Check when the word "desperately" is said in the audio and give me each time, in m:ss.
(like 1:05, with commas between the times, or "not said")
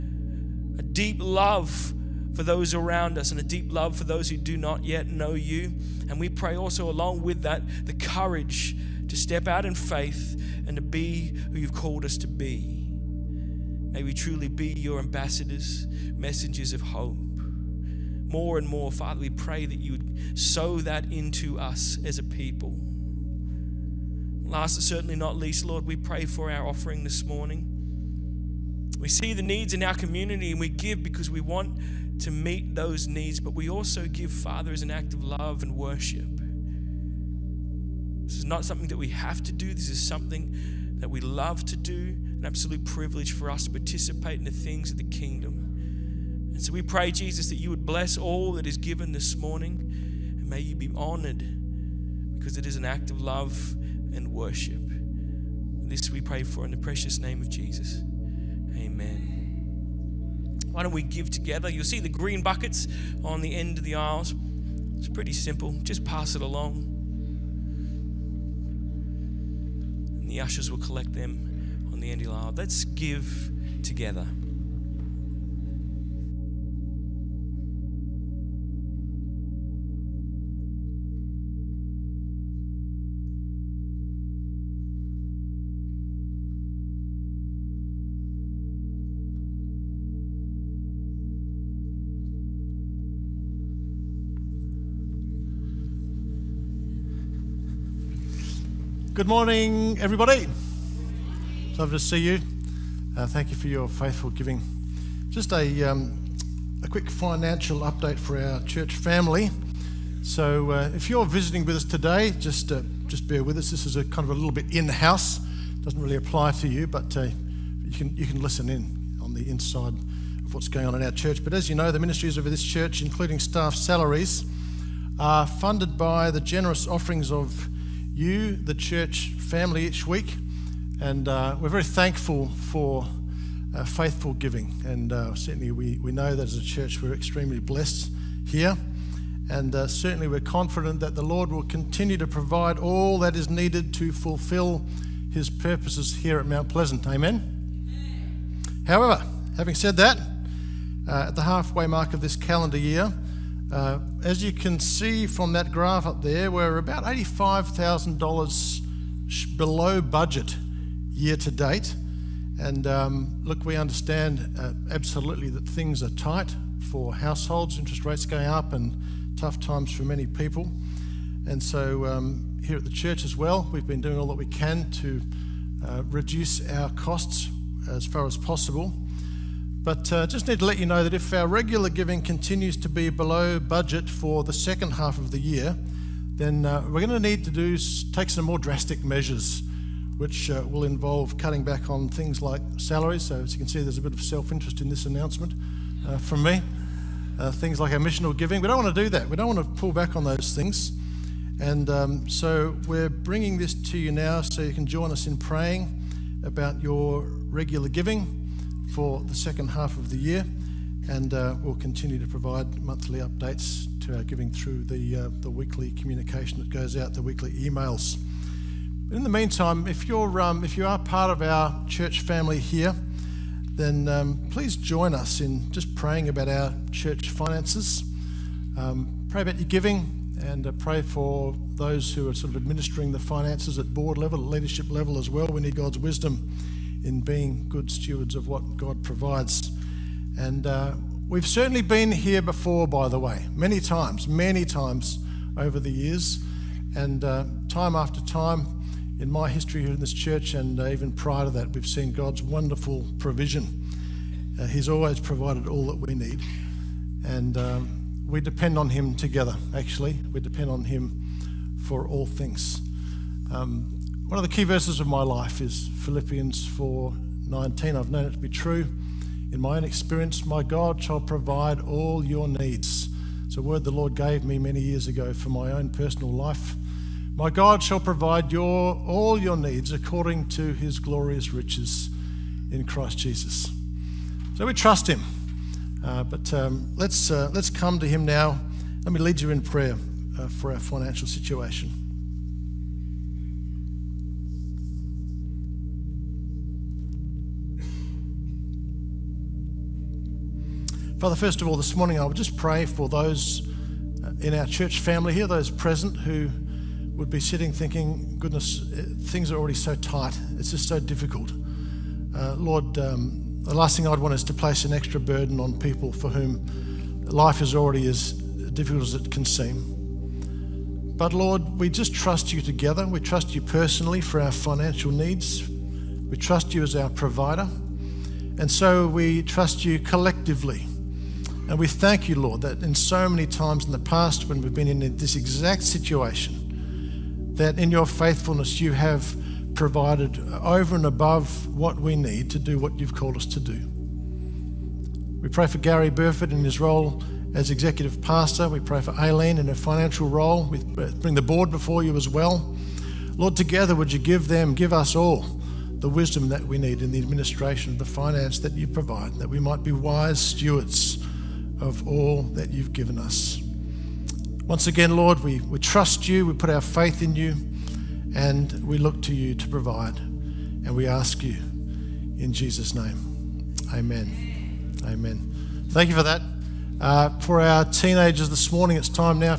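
not said.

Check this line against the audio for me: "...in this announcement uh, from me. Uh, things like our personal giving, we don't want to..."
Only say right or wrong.
wrong.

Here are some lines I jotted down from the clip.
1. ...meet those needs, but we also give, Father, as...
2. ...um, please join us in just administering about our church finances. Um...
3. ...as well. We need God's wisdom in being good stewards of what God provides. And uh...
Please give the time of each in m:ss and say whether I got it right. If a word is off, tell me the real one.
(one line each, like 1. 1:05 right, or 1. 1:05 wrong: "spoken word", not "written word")
1. 0:32 right
2. 3:44 wrong: "praying", not "administering"
3. 3:55 right.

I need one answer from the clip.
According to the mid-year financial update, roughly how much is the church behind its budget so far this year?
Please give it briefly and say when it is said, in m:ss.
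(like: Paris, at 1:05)
$85,000, at 2:37.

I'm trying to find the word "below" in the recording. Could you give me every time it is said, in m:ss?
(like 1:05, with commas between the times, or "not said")
2:39, 3:03.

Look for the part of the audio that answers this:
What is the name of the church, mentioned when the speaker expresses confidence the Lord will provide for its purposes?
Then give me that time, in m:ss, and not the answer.
2:26.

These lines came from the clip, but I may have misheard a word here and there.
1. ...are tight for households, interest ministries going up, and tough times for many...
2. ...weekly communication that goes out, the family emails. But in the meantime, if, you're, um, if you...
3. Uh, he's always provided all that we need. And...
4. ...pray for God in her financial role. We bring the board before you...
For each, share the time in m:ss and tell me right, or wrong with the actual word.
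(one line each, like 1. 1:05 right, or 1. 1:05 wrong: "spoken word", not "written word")
1. 2:46 wrong: "rates", not "ministries"
2. 3:35 wrong: "weekly", not "family"
3. 4:14 right
4. 5:48 wrong: "Aileen", not "God".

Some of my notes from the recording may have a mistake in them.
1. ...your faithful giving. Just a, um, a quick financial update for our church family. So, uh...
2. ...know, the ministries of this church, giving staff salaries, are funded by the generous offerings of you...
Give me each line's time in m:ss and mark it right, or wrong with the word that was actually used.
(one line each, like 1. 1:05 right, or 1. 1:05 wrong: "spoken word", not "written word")
1. 1:43 right
2. 2:01 wrong: "including", not "giving".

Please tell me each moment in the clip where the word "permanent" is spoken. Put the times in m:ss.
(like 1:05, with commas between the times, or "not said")
not said.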